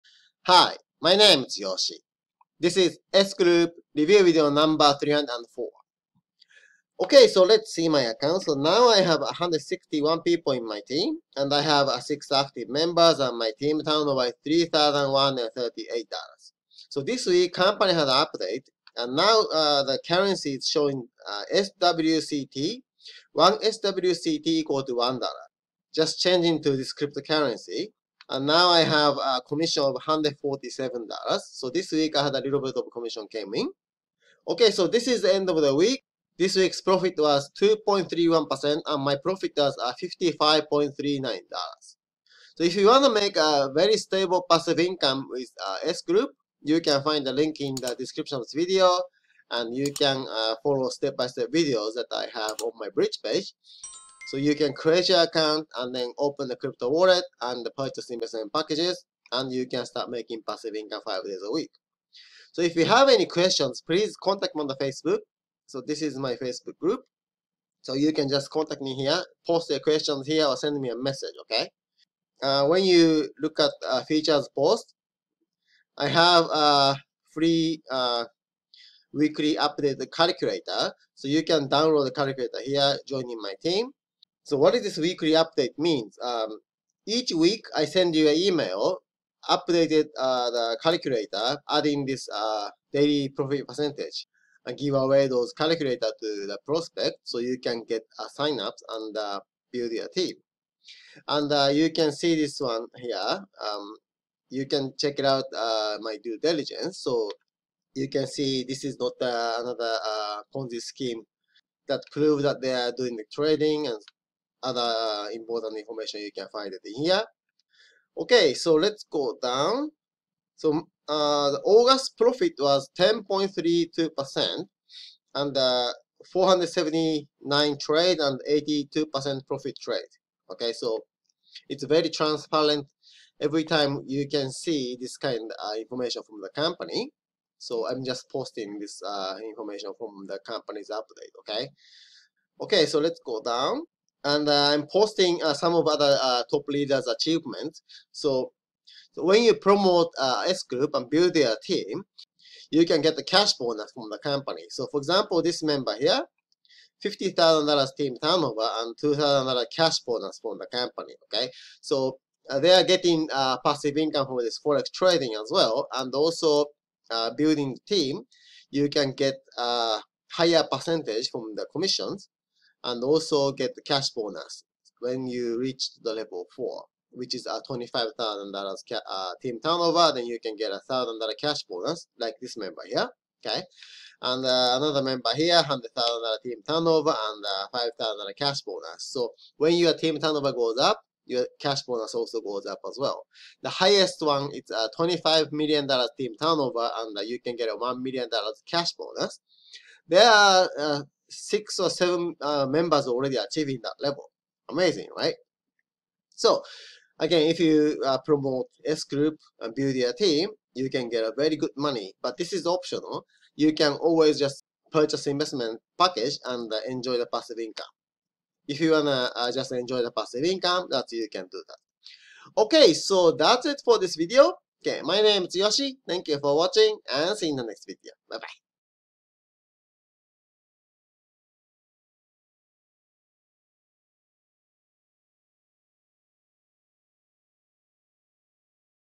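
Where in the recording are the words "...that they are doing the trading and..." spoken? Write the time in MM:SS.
01:52.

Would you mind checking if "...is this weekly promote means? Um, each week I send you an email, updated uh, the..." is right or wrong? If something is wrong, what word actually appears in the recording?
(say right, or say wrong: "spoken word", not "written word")
wrong: "update", not "promote".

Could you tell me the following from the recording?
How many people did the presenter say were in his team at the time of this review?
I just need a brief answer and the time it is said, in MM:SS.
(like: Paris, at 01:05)
161, at 00:09.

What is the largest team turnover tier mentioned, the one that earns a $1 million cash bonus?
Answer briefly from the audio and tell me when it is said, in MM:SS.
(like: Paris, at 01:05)
$25 million, at 03:14.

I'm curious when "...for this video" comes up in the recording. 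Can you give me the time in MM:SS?
03:43.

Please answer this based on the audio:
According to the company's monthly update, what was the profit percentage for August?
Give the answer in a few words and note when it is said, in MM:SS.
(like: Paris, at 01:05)
10.32%, at 02:02.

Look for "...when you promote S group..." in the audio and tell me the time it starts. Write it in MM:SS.
02:29.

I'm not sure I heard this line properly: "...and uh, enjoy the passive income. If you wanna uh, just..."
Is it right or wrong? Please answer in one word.
right.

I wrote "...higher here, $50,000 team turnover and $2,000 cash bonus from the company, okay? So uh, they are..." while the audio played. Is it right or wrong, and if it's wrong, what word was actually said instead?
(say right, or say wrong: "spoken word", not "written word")
wrong: "member", not "higher".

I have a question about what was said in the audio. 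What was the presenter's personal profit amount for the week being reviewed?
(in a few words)
$55.39.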